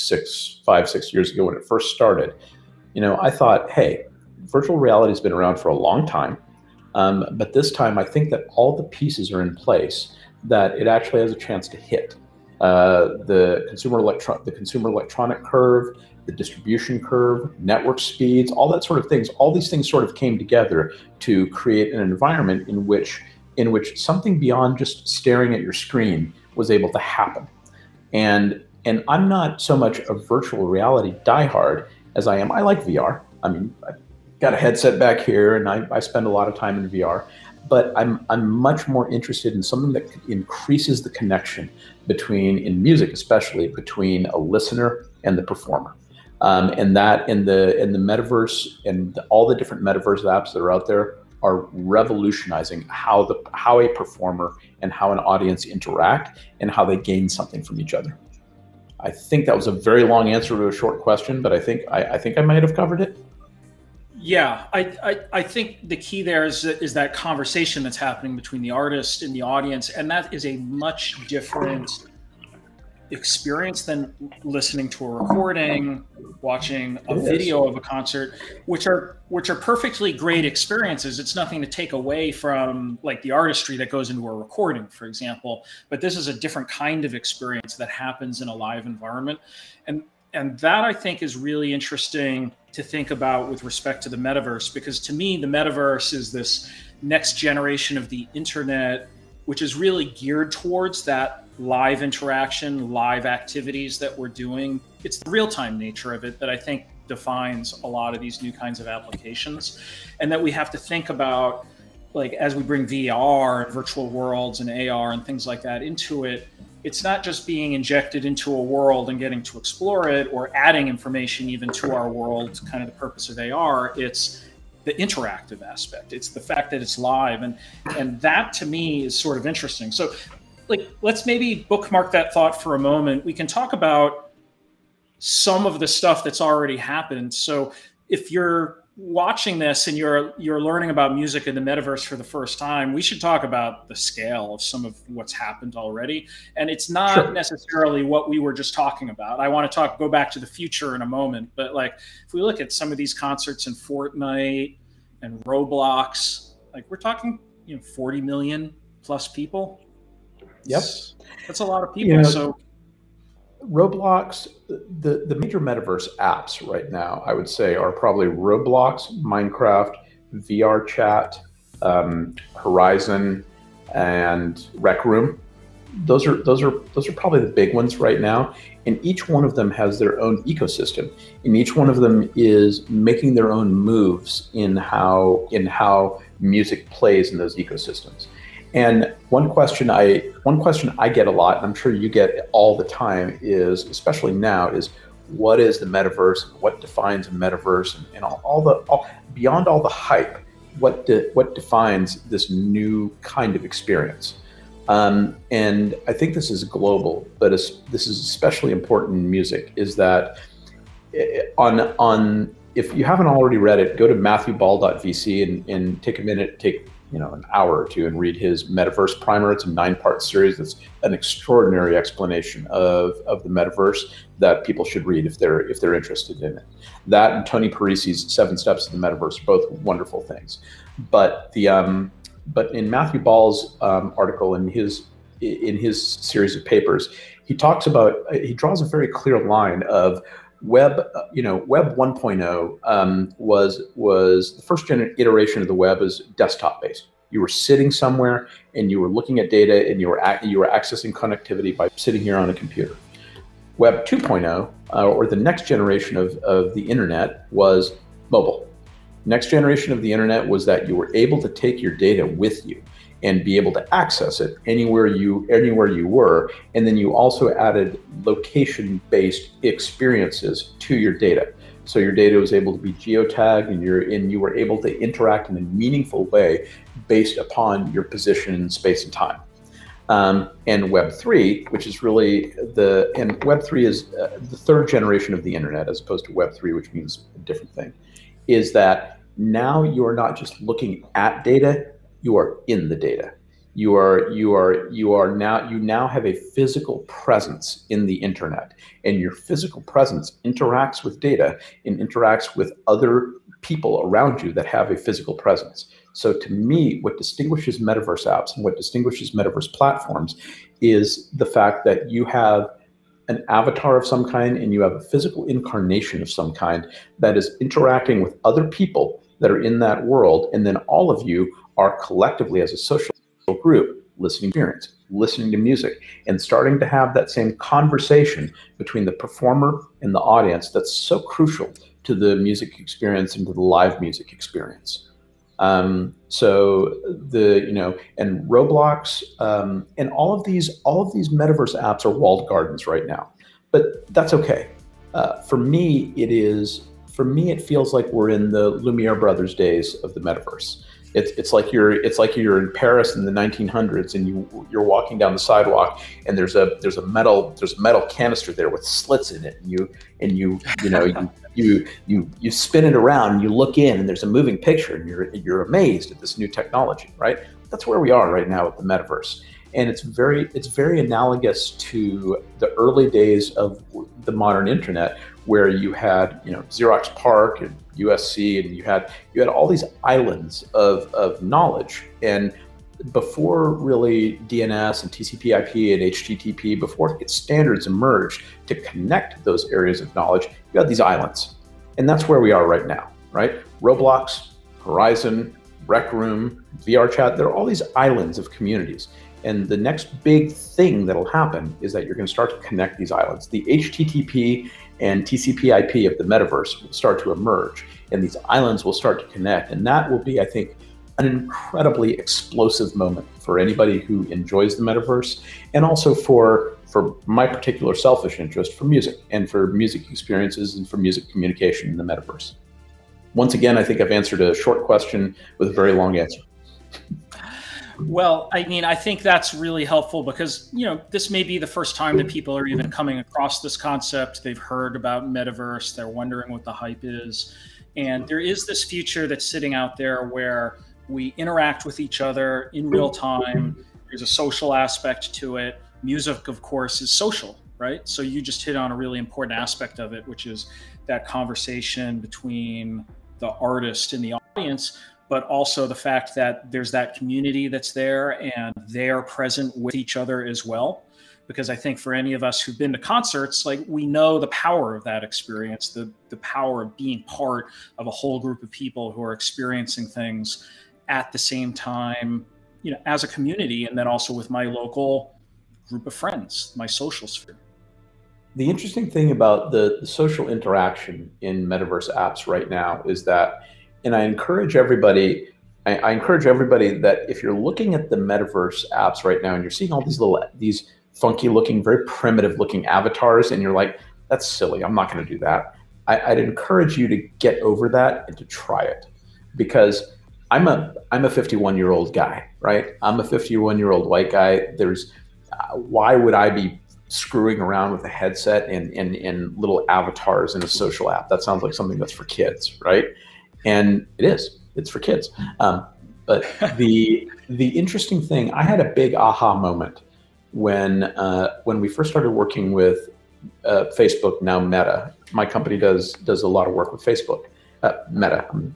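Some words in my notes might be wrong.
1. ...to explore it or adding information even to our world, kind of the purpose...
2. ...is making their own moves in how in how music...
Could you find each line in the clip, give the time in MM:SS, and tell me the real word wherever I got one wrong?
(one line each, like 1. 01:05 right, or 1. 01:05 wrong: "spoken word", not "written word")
1. 01:59 right
2. 03:02 right.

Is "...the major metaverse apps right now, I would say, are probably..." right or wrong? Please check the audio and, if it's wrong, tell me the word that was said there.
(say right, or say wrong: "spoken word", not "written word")
right.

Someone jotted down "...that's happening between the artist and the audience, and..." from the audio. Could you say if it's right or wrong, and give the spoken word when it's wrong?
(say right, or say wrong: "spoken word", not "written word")
right.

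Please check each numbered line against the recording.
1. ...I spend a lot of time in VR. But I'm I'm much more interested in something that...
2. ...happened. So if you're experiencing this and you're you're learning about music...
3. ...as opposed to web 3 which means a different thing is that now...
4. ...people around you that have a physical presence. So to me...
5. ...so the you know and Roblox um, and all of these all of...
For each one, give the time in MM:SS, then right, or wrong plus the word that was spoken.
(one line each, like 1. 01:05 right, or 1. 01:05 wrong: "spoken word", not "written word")
1. 00:35 right
2. 02:16 wrong: "watching", not "experiencing"
3. 04:45 right
4. 05:03 right
5. 05:36 right.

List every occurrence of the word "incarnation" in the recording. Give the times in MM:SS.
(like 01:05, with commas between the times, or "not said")
05:15.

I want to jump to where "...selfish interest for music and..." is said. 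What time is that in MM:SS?
06:57.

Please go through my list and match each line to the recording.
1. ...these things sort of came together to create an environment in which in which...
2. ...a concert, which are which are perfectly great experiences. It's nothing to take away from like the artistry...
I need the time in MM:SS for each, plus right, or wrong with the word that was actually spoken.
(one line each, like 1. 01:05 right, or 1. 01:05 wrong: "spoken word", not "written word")
1. 00:19 right
2. 01:17 right.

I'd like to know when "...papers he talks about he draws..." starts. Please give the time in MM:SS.
03:56.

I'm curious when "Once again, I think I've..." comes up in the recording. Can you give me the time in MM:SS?
07:03.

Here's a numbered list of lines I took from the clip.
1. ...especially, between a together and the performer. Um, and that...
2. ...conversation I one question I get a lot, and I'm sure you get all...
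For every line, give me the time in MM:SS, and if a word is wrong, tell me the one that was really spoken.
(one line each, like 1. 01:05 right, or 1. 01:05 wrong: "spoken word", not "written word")
1. 00:43 wrong: "listener", not "together"
2. 03:09 wrong: "question", not "conversation".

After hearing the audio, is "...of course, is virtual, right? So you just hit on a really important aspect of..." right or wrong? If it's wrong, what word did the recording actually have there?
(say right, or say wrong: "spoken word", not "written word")
wrong: "social", not "virtual".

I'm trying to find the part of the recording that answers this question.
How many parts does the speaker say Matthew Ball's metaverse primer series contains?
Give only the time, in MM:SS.
03:39.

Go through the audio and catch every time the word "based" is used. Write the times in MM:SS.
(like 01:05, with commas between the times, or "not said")
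04:06, 04:29, 04:37.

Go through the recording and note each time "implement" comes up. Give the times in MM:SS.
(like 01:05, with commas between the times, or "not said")
not said.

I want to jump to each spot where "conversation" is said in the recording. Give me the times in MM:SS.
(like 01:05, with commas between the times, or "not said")
01:07, 05:27, 07:31.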